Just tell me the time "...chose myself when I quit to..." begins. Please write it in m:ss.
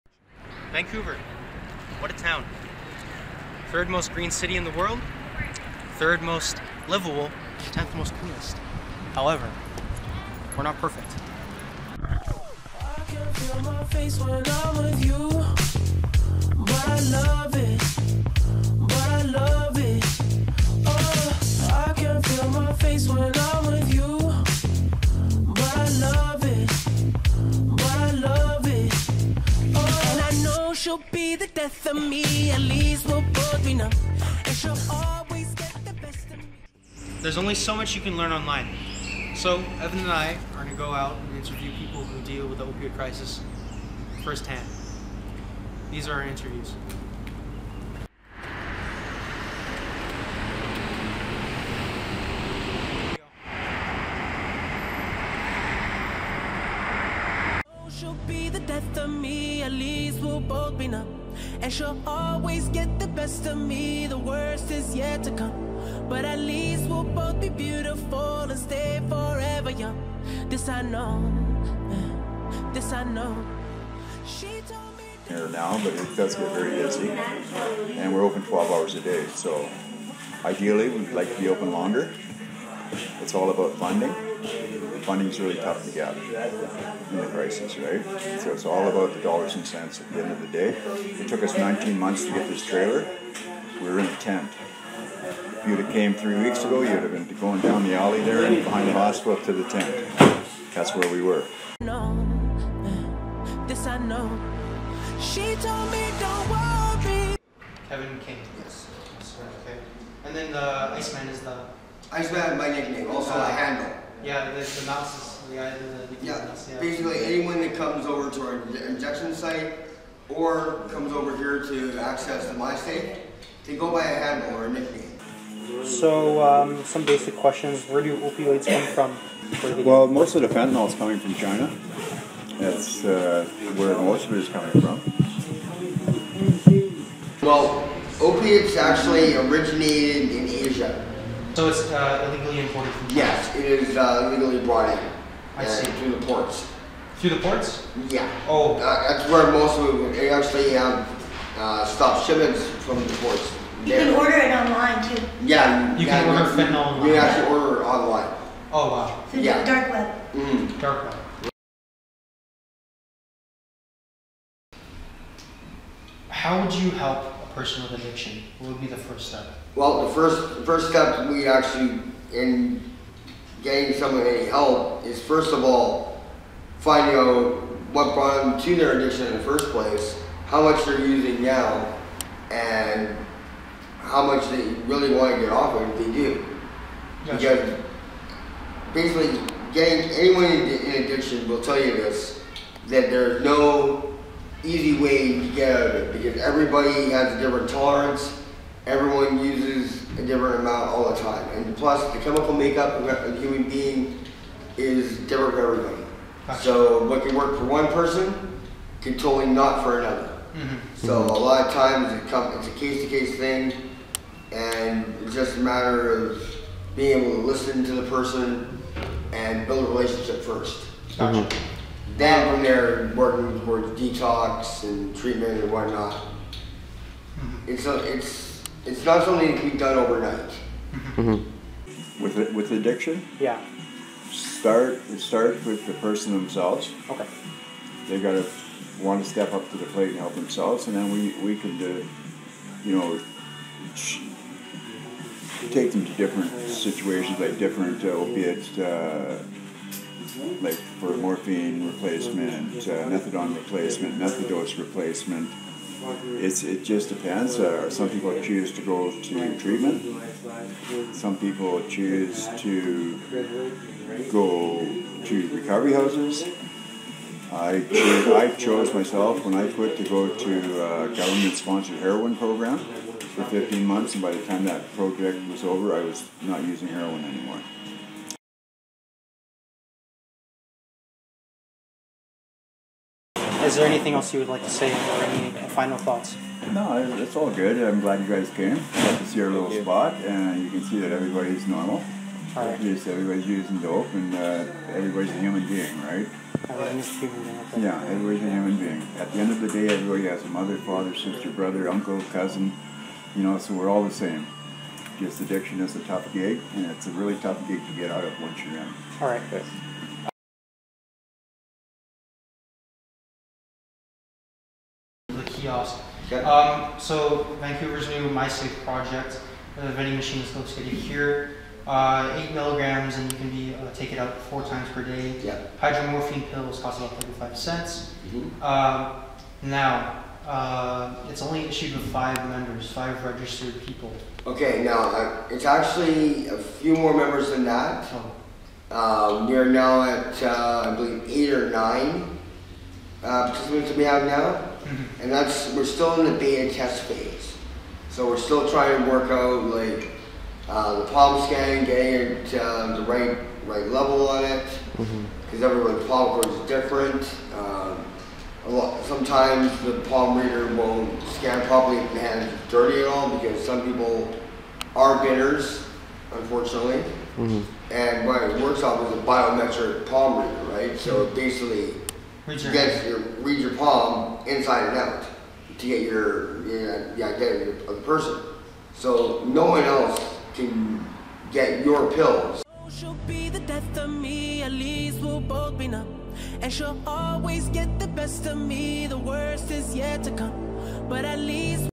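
4:28.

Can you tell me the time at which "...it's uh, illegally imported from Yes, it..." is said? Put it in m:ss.
2:21.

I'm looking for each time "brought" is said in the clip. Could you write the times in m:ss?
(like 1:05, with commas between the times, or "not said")
2:24, 2:58.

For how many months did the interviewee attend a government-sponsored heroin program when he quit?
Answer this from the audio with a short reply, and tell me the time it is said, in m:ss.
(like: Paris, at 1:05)
15, at 4:33.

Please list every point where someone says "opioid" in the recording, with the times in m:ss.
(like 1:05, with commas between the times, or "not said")
0:42, 2:08.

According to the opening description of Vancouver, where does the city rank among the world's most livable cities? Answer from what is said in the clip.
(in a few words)
3rd.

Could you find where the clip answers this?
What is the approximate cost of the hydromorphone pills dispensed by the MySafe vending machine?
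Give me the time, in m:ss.
5:27.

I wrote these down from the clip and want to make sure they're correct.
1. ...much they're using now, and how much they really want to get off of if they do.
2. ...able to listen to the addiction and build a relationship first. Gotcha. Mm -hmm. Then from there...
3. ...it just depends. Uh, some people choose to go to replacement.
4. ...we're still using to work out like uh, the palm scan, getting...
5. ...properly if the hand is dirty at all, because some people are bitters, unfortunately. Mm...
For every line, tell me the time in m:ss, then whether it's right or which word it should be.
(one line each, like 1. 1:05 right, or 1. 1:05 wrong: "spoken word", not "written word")
1. 3:00 right
2. 3:37 wrong: "person", not "addiction"
3. 4:16 wrong: "treatment", not "replacement"
4. 5:48 wrong: "trying", not "using"
5. 6:01 right.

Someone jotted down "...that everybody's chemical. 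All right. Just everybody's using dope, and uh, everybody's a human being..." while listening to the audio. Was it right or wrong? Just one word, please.
wrong.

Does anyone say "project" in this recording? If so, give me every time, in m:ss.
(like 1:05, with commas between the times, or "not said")
4:34, 5:18.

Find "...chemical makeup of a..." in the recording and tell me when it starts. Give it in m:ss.
3:22.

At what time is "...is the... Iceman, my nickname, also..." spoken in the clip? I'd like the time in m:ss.
1:51.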